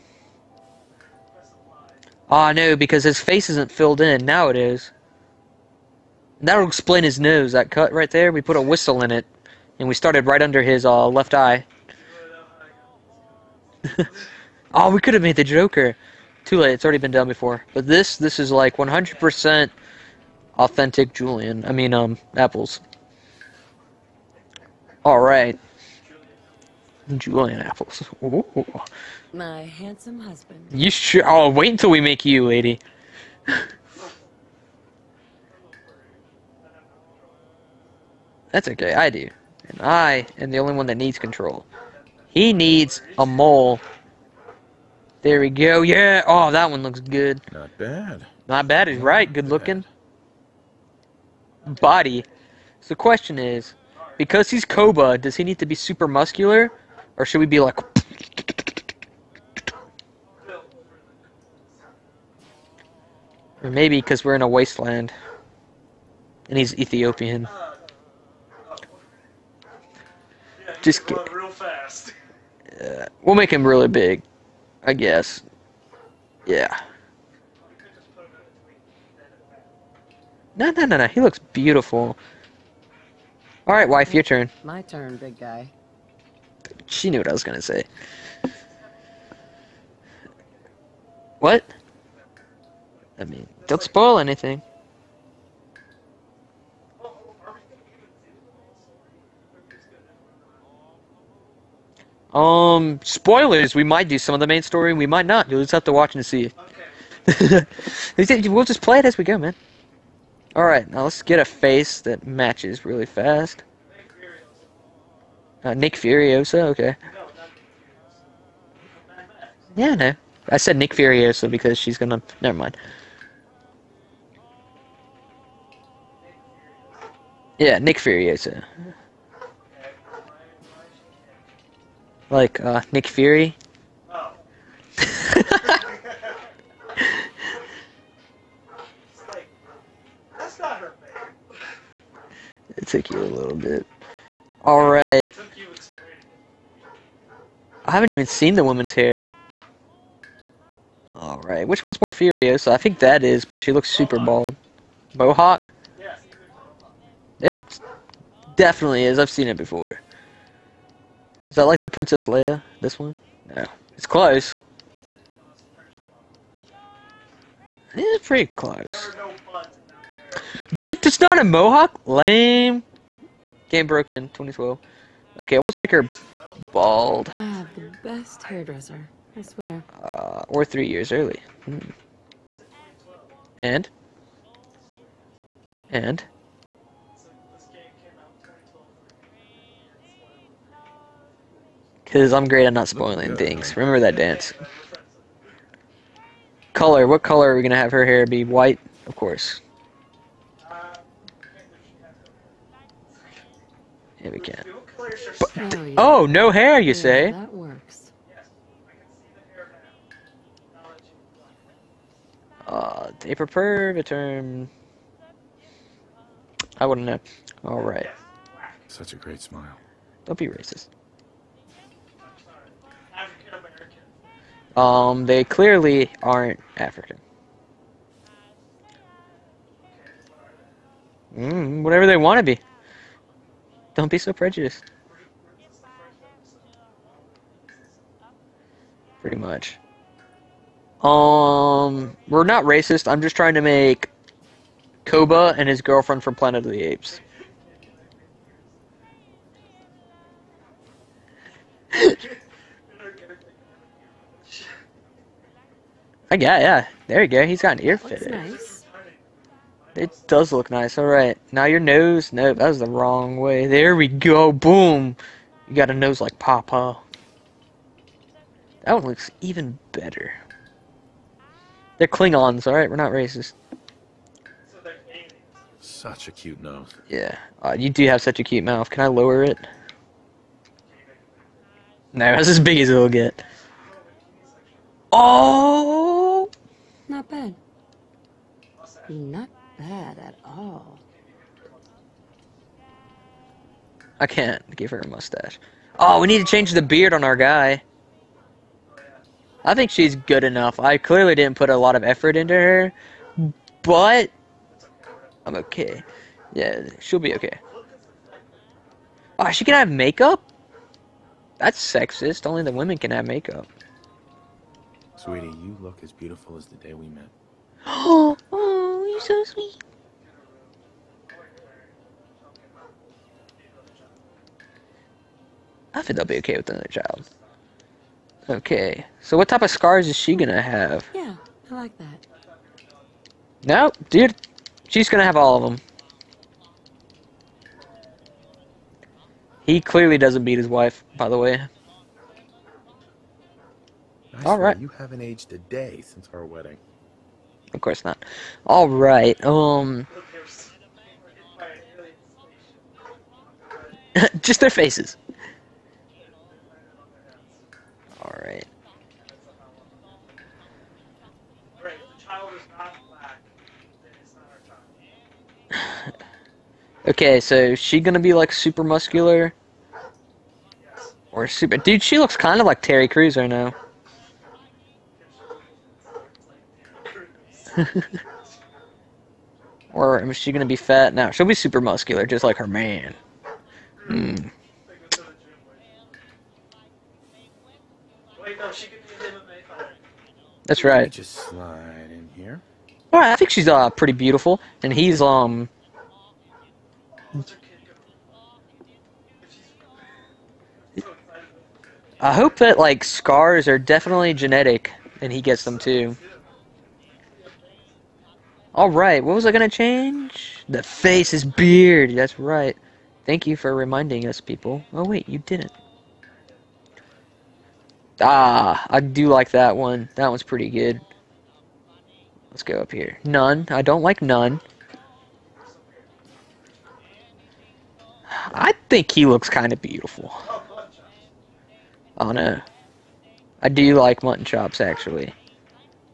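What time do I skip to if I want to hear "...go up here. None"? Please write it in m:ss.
7:02.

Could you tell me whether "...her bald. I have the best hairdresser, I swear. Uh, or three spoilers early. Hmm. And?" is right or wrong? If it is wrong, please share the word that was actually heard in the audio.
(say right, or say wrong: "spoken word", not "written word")
wrong: "years", not "spoilers".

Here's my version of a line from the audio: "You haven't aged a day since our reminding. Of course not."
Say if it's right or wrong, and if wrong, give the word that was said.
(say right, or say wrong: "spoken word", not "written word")
wrong: "wedding", not "reminding".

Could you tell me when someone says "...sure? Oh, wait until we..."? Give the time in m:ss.
0:30.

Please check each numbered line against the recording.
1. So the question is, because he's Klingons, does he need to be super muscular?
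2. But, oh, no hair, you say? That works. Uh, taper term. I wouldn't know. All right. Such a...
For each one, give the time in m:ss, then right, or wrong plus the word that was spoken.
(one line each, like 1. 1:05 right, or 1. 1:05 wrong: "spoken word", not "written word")
1. 0:52 wrong: "Koba", not "Klingons"
2. 3:25 right.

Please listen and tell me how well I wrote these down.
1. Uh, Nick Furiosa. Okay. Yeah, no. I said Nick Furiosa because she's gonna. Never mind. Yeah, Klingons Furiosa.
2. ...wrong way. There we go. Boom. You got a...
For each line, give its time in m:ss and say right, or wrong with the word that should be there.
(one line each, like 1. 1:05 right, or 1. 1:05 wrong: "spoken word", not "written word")
1. 1:55 wrong: "Nick", not "Klingons"
2. 4:22 right.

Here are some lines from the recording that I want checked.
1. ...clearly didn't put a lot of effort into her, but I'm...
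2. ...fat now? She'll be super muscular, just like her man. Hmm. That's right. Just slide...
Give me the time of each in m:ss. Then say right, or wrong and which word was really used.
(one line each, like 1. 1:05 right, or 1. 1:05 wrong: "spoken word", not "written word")
1. 5:00 right
2. 6:20 right.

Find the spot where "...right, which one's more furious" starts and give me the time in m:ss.
2:31.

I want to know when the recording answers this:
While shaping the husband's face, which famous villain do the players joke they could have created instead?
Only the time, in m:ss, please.
0:15.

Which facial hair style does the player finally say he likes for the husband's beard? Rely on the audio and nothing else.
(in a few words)
Mutton chops.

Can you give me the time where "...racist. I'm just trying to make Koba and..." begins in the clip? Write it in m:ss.
4:02.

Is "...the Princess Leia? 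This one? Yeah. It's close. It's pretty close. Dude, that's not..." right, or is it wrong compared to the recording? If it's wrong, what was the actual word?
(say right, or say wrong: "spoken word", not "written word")
right.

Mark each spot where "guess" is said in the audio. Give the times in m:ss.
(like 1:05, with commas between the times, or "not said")
1:14.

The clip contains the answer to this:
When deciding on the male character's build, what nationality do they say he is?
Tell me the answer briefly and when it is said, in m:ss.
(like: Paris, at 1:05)
Ethiopian, at 1:06.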